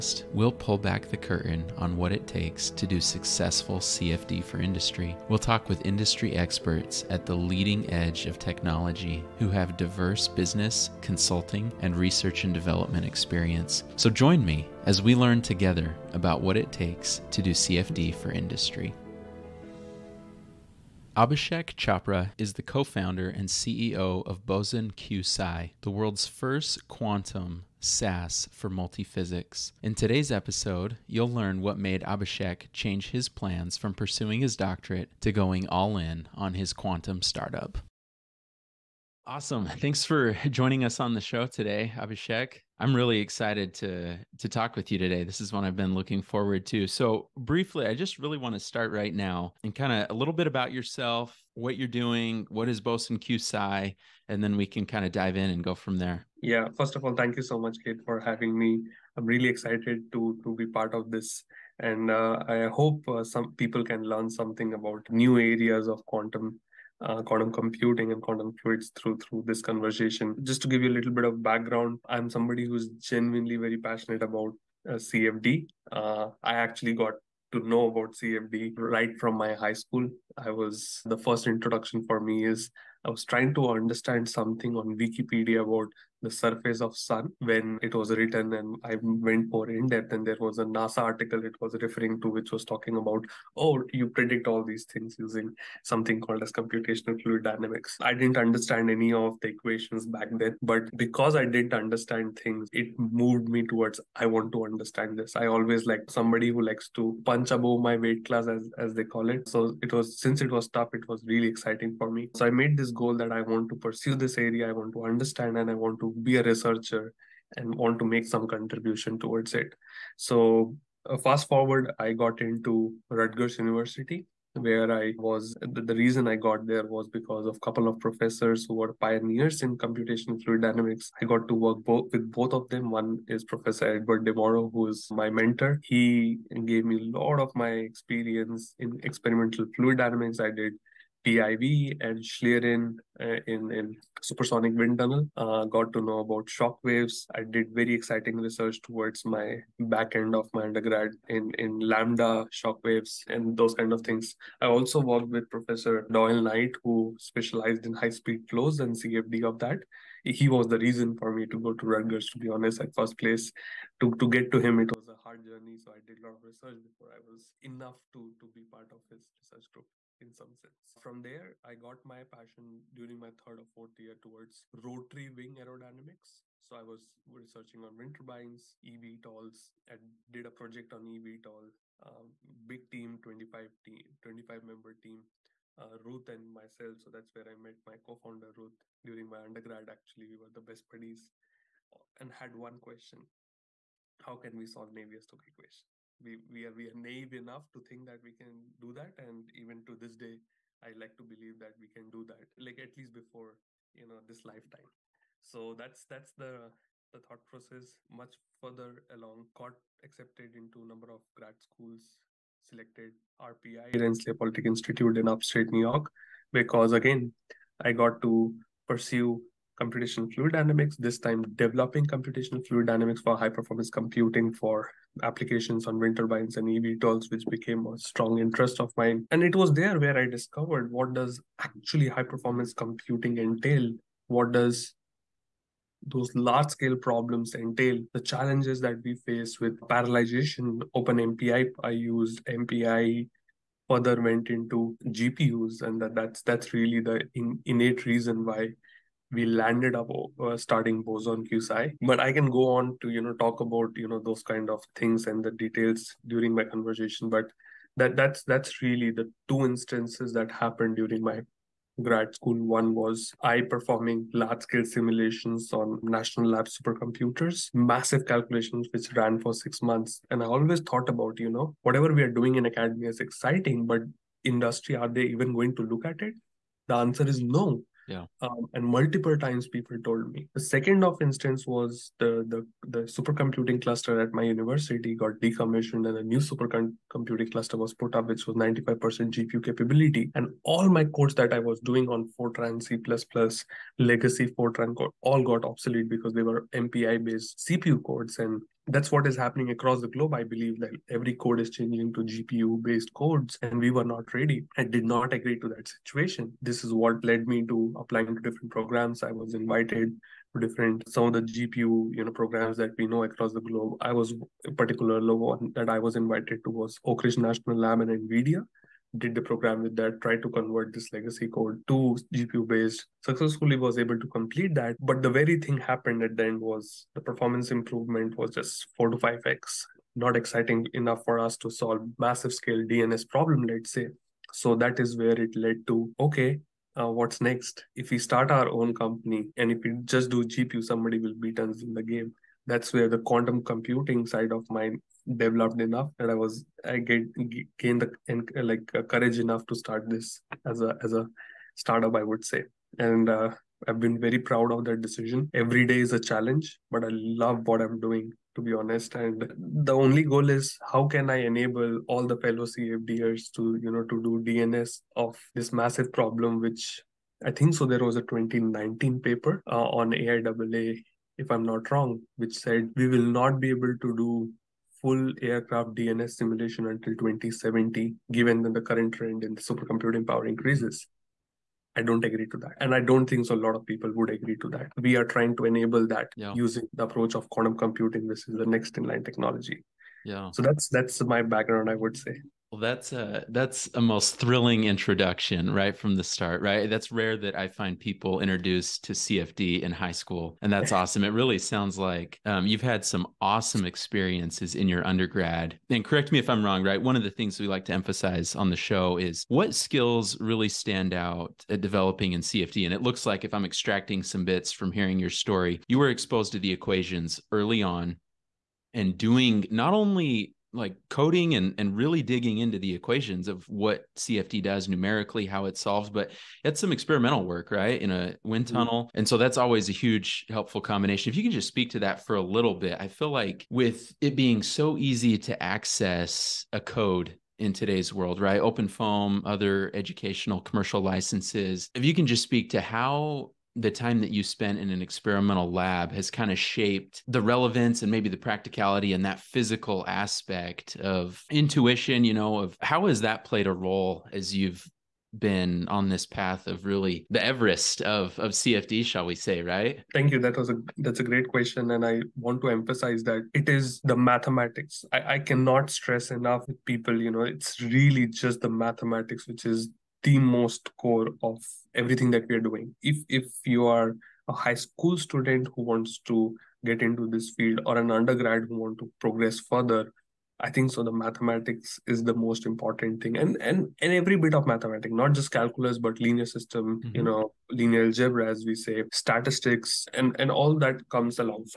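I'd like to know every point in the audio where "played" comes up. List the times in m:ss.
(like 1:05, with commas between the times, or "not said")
7:33.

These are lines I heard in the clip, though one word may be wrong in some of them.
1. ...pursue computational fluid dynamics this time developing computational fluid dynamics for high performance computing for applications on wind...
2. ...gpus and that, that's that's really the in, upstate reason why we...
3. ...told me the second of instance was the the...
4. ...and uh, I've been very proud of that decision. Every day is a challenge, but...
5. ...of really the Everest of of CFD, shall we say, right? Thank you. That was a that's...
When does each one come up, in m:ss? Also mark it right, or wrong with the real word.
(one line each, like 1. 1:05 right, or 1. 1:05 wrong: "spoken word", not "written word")
1. 3:38 right
2. 4:05 wrong: "innate", not "upstate"
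3. 4:40 right
4. 5:52 right
5. 7:36 right.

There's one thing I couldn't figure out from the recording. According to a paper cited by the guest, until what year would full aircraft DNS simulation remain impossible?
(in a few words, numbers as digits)
2070.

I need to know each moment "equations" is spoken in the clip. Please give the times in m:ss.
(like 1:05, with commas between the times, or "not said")
1:39, 3:15, 6:56, 7:02.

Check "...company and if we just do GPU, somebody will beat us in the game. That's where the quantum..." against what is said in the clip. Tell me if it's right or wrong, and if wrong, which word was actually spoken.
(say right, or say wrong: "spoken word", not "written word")
right.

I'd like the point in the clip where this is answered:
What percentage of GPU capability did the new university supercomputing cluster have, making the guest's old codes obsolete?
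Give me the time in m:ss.
4:48.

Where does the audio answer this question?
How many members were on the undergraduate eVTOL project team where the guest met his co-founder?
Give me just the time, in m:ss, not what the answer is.
3:04.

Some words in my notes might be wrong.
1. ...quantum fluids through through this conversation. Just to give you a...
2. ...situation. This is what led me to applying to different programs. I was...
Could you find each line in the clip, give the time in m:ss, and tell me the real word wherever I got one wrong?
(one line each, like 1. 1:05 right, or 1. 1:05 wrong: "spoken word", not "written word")
1. 1:08 right
2. 5:05 right.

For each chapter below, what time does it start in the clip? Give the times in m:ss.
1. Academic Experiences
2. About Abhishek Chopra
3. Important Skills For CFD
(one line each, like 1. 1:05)
1. 0:38
2. 0:20
3. 7:10.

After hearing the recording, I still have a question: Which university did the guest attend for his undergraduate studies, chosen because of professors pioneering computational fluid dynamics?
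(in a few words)
Rutgers University.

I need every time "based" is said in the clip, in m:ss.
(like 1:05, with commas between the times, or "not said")
4:57, 5:02, 5:22.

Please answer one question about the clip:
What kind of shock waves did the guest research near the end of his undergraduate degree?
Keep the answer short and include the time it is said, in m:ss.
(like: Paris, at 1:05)
Lambda shock waves, at 2:31.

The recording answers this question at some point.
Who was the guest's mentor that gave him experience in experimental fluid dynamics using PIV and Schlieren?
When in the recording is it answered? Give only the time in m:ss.
2:13.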